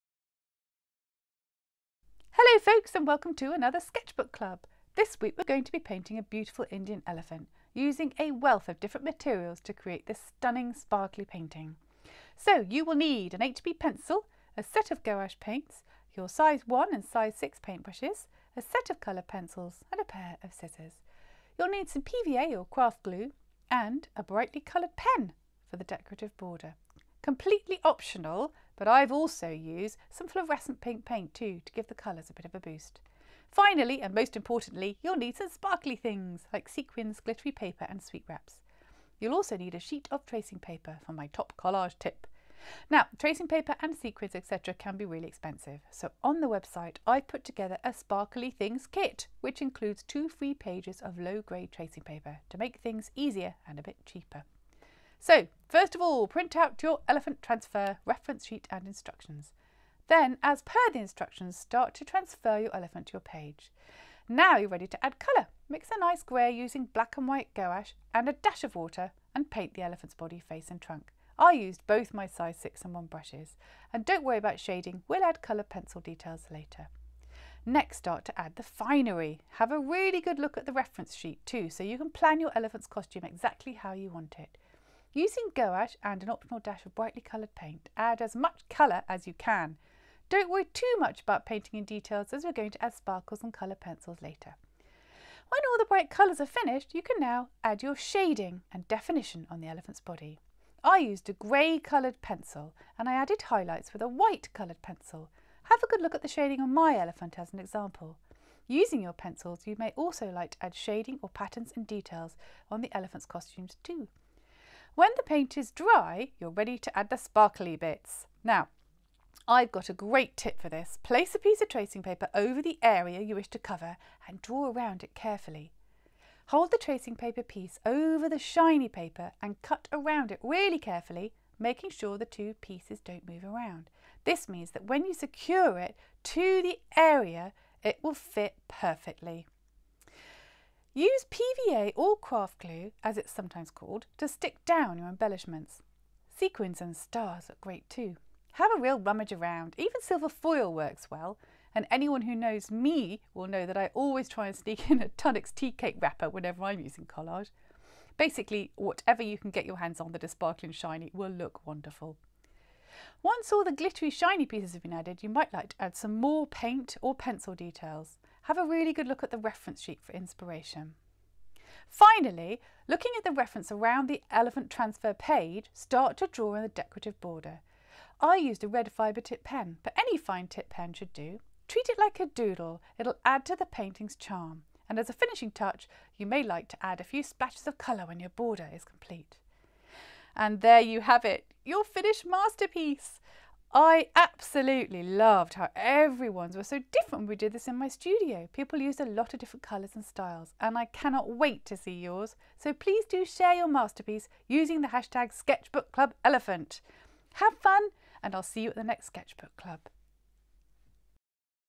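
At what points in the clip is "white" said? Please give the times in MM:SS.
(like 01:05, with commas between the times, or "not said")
01:07, 01:44.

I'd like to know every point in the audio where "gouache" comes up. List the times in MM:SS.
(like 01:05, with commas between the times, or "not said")
00:15, 01:07, 01:25.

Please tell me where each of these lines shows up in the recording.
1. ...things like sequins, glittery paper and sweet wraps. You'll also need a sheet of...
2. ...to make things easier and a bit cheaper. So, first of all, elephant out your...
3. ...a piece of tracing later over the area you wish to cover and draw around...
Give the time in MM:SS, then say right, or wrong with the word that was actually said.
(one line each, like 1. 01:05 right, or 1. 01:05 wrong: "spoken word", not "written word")
1. 00:35 right
2. 00:52 wrong: "print", not "elephant"
3. 02:01 wrong: "paper", not "later".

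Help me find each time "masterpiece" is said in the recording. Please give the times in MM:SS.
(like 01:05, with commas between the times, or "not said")
03:12, 03:23.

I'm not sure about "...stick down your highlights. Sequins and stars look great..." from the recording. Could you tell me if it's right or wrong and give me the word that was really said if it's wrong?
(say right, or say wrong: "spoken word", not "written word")
wrong: "embellishments", not "highlights".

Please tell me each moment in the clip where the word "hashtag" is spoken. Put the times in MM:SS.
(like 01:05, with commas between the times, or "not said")
03:24.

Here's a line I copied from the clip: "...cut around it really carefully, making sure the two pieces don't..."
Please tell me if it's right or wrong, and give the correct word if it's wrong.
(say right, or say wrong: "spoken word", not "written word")
right.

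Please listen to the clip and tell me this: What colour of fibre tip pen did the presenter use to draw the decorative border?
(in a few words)
Red.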